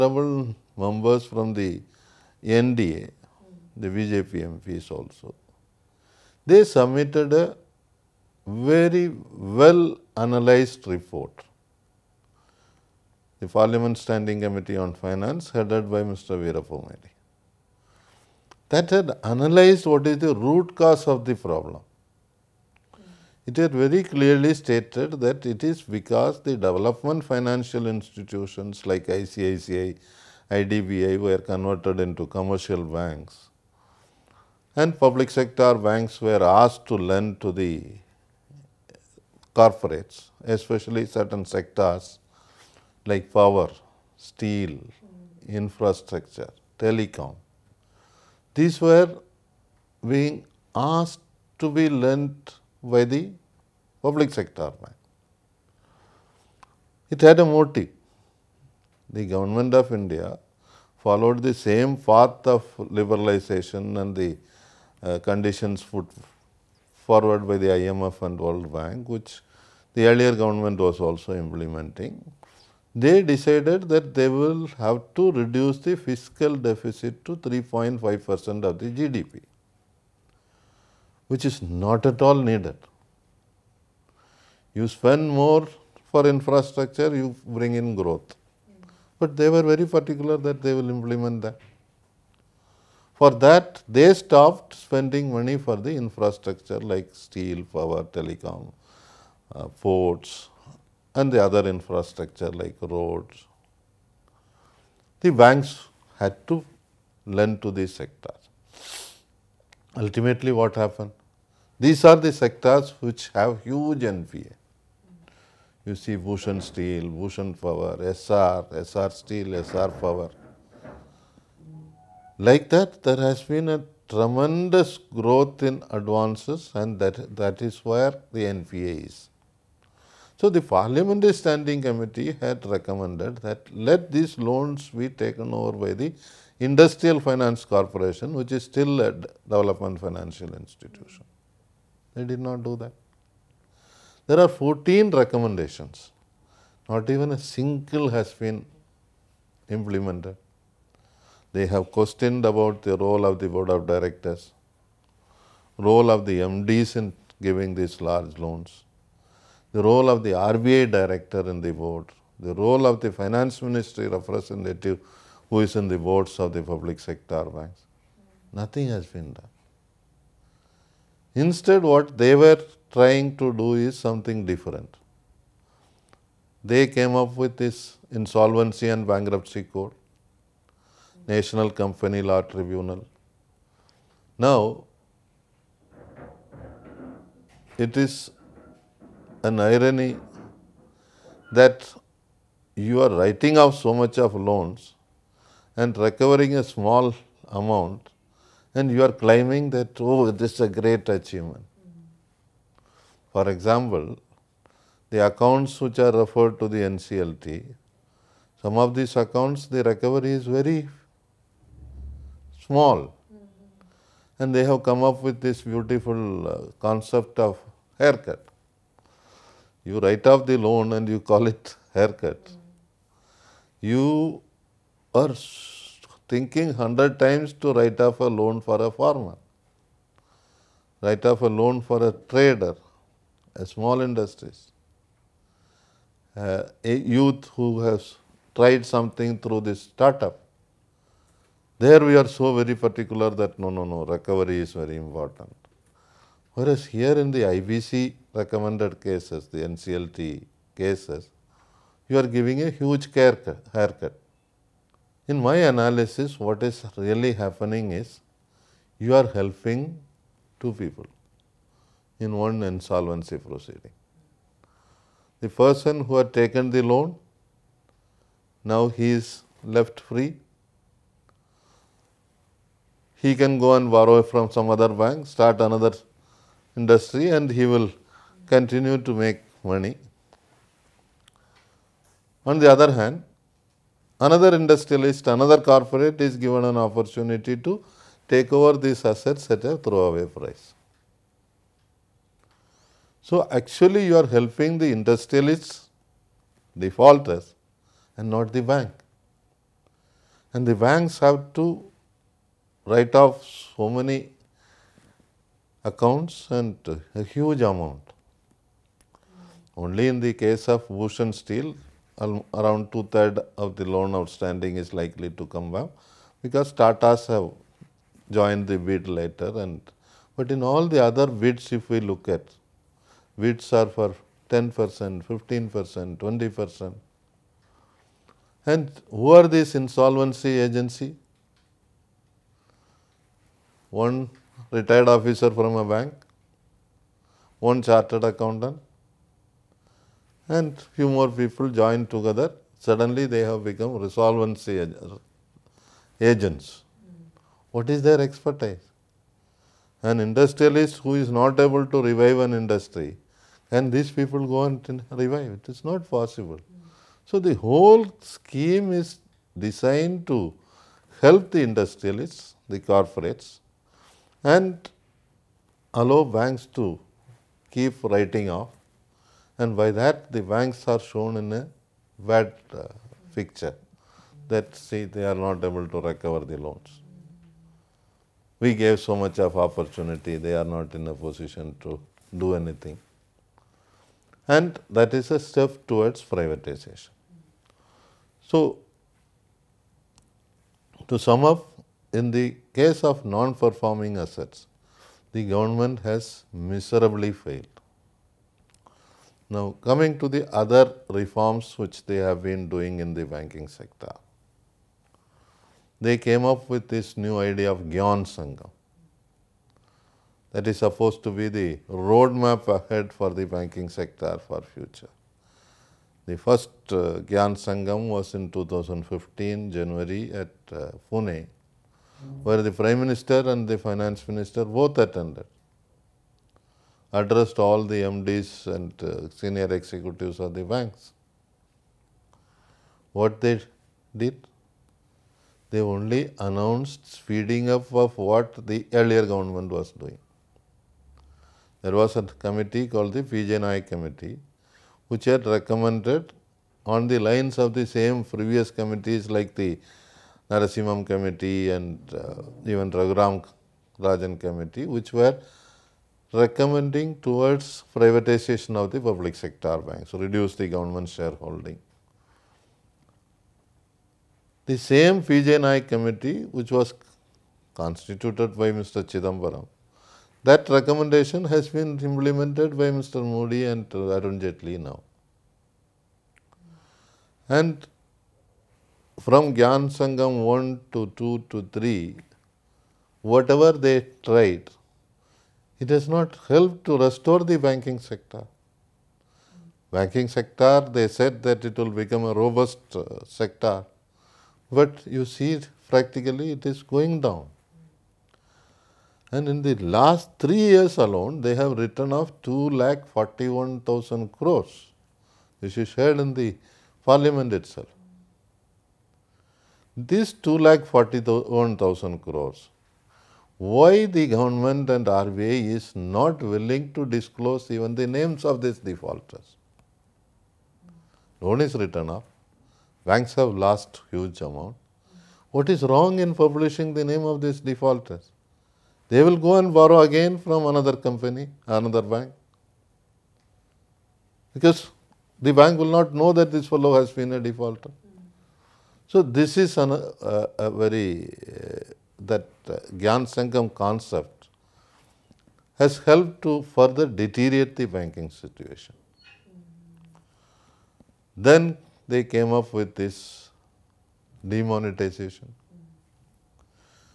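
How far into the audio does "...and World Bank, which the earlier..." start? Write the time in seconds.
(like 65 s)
68 s.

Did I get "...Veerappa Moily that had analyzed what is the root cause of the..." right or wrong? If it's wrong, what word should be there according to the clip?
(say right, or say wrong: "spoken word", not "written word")
right.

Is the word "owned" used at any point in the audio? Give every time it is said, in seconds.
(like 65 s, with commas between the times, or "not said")
not said.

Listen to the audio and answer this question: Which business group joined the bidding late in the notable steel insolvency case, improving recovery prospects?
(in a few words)
Tatas.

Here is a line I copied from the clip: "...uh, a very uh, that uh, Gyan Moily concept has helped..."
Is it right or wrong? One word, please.
wrong.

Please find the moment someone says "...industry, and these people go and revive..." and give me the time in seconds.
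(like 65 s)
352 s.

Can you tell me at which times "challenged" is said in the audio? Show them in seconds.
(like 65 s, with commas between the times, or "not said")
not said.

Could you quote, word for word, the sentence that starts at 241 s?
There we are so very particular that no, no, no, recovery is very important.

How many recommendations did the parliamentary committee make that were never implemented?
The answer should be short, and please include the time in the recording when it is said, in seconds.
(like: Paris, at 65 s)
14, at 144 s.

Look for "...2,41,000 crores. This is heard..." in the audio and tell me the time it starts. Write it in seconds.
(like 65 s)
502 s.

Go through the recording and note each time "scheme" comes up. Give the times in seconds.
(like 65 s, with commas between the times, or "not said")
358 s.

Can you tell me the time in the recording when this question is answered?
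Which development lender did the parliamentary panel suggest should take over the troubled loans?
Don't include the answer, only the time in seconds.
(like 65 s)
136 s.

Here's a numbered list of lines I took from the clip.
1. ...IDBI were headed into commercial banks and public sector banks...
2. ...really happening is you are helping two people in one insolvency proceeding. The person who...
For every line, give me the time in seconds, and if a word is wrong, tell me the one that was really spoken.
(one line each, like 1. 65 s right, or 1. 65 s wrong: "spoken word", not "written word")
1. 30 s wrong: "converted", not "headed"
2. 256 s right.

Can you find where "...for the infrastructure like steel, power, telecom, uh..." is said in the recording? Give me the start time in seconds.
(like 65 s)
95 s.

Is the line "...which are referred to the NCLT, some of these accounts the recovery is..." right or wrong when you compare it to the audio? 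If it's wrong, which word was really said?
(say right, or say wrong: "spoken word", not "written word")
right.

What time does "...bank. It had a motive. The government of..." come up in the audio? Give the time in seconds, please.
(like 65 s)
54 s.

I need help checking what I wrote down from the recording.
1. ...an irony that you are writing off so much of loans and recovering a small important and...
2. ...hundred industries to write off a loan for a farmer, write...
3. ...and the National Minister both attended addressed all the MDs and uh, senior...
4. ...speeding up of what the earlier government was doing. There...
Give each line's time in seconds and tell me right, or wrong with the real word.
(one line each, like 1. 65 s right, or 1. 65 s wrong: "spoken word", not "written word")
1. 189 s wrong: "amount", not "important"
2. 226 s wrong: "times", not "industries"
3. 423 s wrong: "Finance", not "National"
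4. 437 s right.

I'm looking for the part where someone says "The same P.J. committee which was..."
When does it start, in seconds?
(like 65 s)
464 s.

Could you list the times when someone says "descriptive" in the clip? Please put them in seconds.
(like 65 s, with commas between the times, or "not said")
not said.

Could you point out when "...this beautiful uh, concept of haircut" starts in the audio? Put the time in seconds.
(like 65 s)
215 s.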